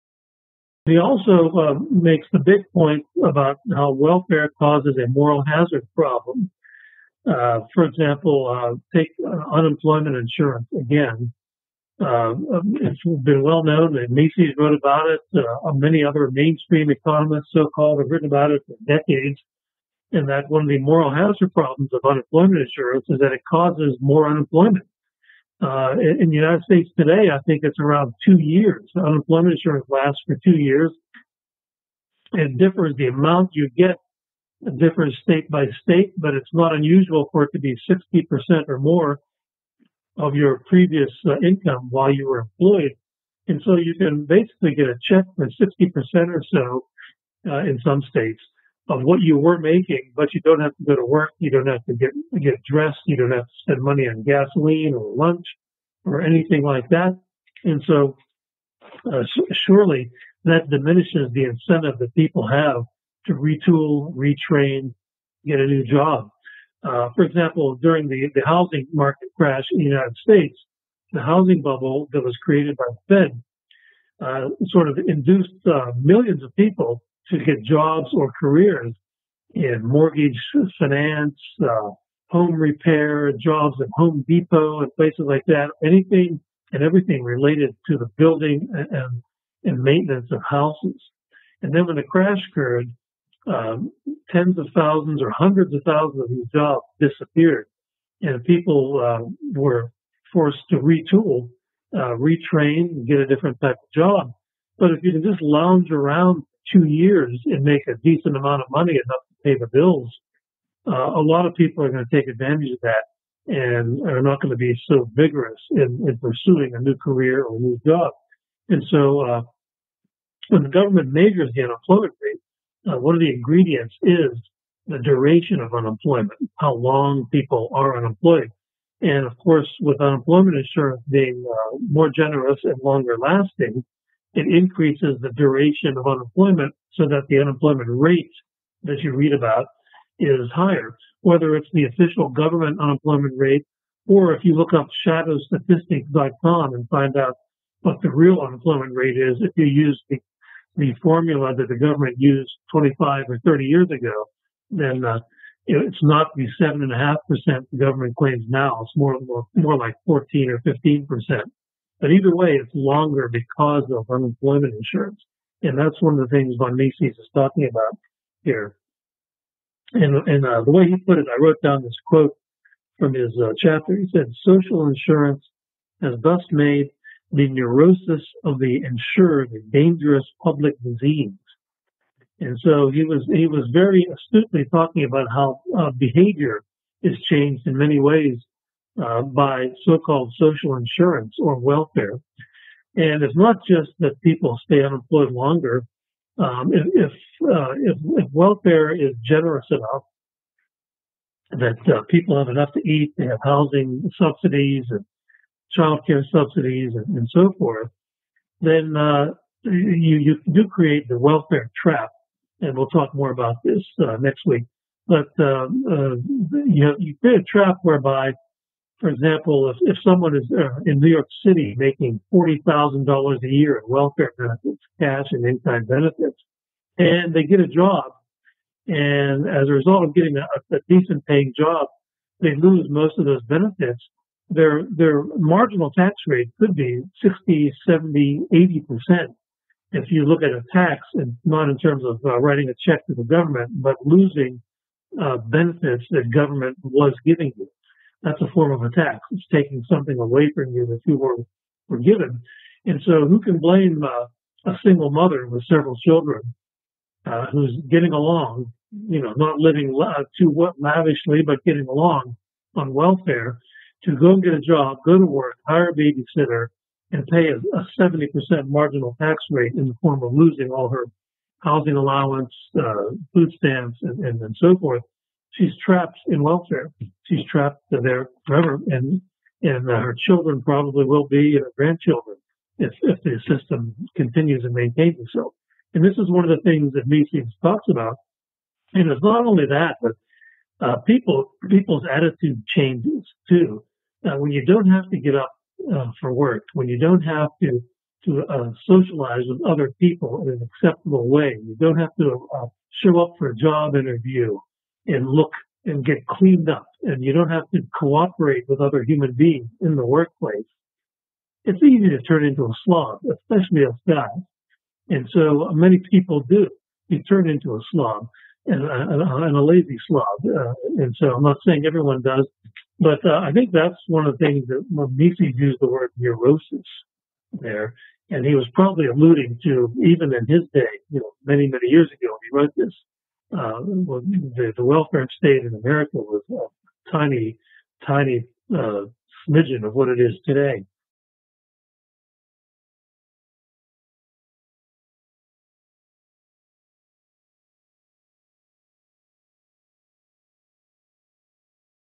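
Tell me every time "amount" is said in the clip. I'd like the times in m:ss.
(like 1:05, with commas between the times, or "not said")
0:33, 1:48.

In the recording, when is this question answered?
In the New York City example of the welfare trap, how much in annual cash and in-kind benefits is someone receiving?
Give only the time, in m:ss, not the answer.
3:42.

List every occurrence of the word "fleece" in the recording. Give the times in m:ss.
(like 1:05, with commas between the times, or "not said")
not said.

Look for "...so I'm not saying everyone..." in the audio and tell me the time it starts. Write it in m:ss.
5:21.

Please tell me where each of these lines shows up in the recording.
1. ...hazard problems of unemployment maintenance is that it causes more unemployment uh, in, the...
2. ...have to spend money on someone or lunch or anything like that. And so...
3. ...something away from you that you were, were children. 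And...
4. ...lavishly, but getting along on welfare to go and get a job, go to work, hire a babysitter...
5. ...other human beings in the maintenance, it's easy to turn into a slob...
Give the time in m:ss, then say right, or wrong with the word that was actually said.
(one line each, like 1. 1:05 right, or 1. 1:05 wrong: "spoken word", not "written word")
1. 0:21 wrong: "insurance", not "maintenance"
2. 0:53 wrong: "gasoline", not "someone"
3. 4:09 wrong: "given", not "children"
4. 4:20 right
5. 5:08 wrong: "workplace", not "maintenance".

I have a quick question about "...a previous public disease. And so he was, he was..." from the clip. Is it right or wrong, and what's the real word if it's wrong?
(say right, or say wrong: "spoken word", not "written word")
wrong: "dangerous", not "previous".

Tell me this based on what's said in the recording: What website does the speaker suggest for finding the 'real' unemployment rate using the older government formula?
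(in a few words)
shadowstatistics.com.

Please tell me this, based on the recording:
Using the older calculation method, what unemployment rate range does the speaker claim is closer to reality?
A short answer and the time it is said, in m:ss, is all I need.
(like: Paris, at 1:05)
14 or 15%, at 2:40.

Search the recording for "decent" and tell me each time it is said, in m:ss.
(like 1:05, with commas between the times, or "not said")
1:47, 3:50.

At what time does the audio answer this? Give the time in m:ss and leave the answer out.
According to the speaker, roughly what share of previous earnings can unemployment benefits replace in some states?
0:37.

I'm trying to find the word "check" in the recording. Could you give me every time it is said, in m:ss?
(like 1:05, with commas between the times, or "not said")
0:45, 4:02.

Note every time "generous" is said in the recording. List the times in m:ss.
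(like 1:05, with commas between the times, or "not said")
2:12, 3:19.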